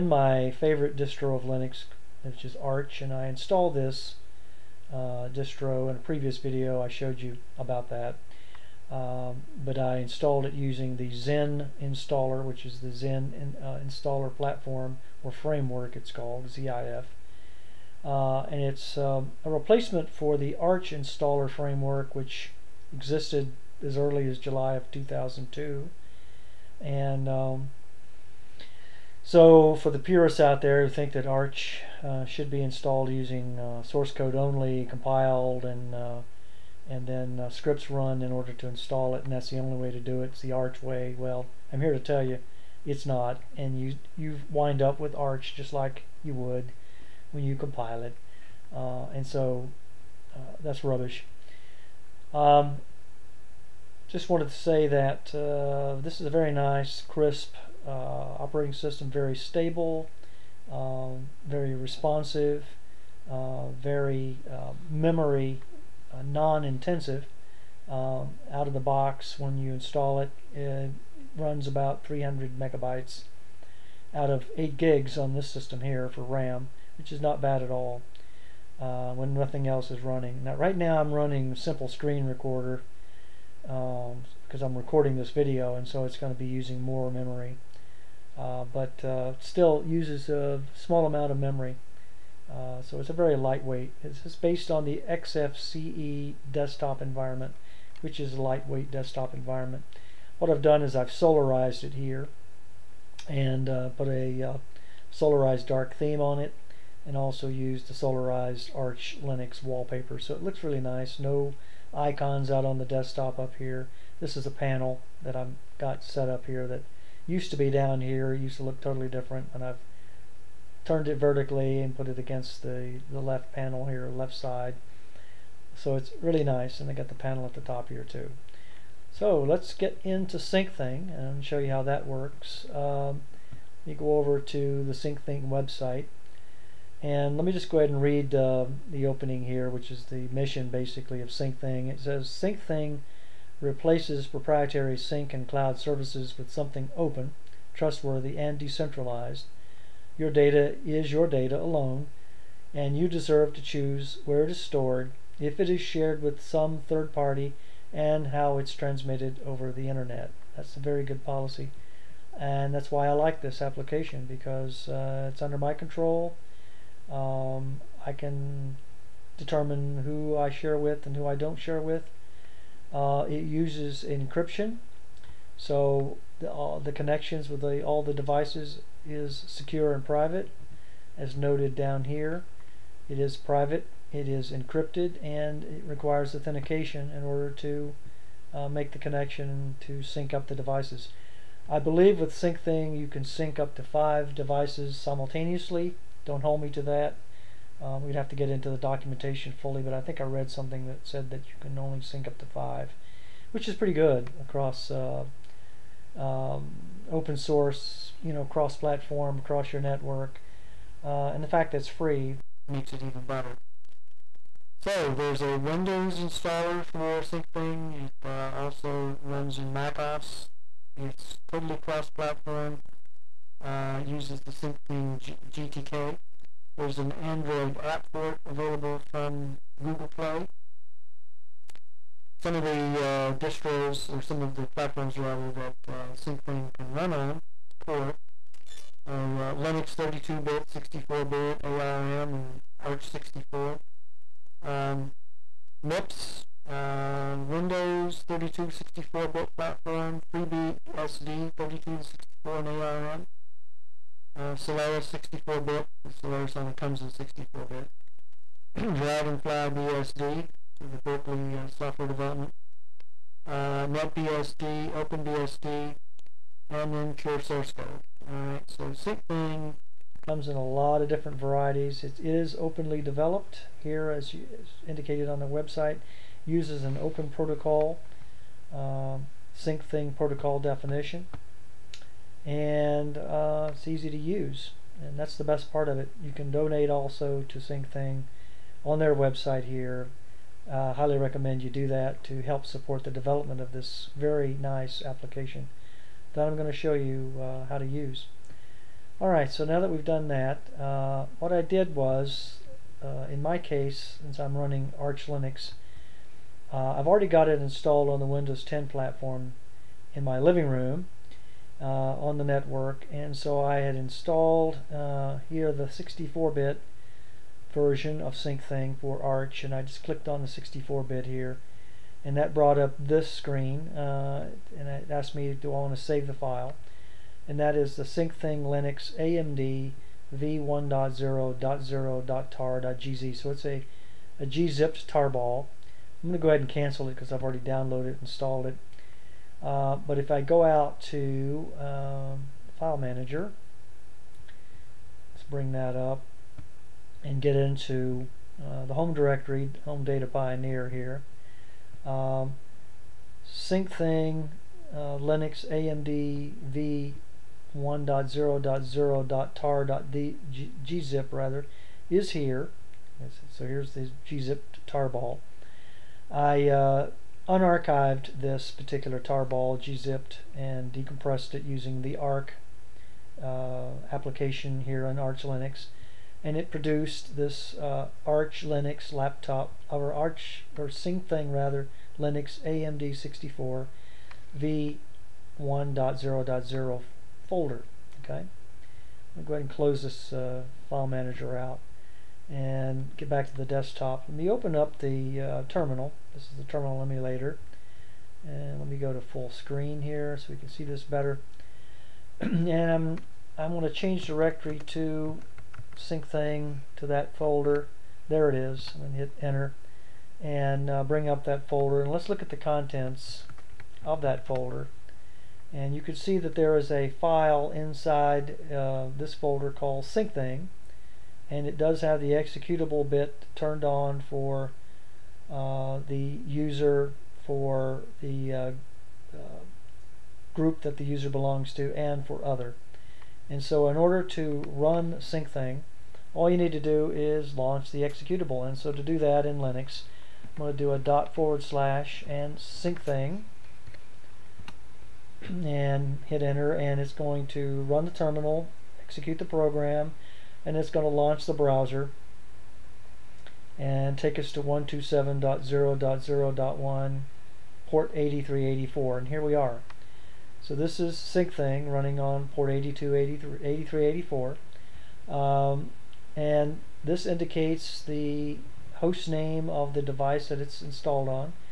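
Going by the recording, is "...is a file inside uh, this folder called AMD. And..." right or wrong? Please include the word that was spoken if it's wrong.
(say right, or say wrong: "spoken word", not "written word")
wrong: "Syncthing", not "AMD".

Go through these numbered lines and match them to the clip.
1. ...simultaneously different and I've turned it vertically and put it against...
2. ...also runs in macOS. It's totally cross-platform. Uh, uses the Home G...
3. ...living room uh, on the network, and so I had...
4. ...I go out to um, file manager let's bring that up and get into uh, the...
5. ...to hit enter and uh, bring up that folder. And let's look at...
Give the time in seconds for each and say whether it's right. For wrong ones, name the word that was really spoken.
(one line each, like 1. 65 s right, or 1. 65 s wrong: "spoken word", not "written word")
1. 118 s wrong: "totally", not "simultaneously"
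2. 218 s wrong: "Syncthing", not "Home"
3. 310 s right
4. 340 s right
5. 409 s right.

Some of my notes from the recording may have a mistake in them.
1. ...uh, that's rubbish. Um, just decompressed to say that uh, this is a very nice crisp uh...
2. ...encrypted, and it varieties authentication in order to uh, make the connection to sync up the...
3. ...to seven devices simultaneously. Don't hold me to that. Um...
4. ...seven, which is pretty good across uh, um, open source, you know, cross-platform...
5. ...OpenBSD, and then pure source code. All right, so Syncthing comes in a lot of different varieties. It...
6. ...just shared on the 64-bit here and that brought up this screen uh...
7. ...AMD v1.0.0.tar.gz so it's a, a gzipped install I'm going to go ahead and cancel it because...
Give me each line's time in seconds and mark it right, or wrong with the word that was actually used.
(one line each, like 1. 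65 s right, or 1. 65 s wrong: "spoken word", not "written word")
1. 50 s wrong: "wanted", not "decompressed"
2. 184 s wrong: "requires", not "varieties"
3. 193 s wrong: "five", not "seven"
4. 202 s wrong: "five", not "seven"
5. 264 s right
6. 319 s wrong: "clicked", not "shared"
7. 329 s wrong: "tarball", not "install".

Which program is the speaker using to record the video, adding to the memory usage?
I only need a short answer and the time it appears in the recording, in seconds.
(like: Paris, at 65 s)
Simple Screen Recorder, at 81 s.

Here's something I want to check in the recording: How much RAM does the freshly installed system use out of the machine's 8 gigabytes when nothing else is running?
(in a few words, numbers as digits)
300 megabytes.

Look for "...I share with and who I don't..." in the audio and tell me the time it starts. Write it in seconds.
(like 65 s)
170 s.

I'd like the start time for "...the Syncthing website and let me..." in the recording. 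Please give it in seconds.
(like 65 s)
134 s.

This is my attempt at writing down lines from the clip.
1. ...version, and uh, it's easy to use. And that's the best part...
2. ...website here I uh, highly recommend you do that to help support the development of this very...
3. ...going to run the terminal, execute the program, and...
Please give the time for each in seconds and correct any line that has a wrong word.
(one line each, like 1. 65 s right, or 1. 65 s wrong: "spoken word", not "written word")
1. 280 s wrong: "definition", not "version"
2. 289 s right
3. 447 s right.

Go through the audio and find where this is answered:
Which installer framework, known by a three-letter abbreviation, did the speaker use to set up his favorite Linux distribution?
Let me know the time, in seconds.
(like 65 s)
16 s.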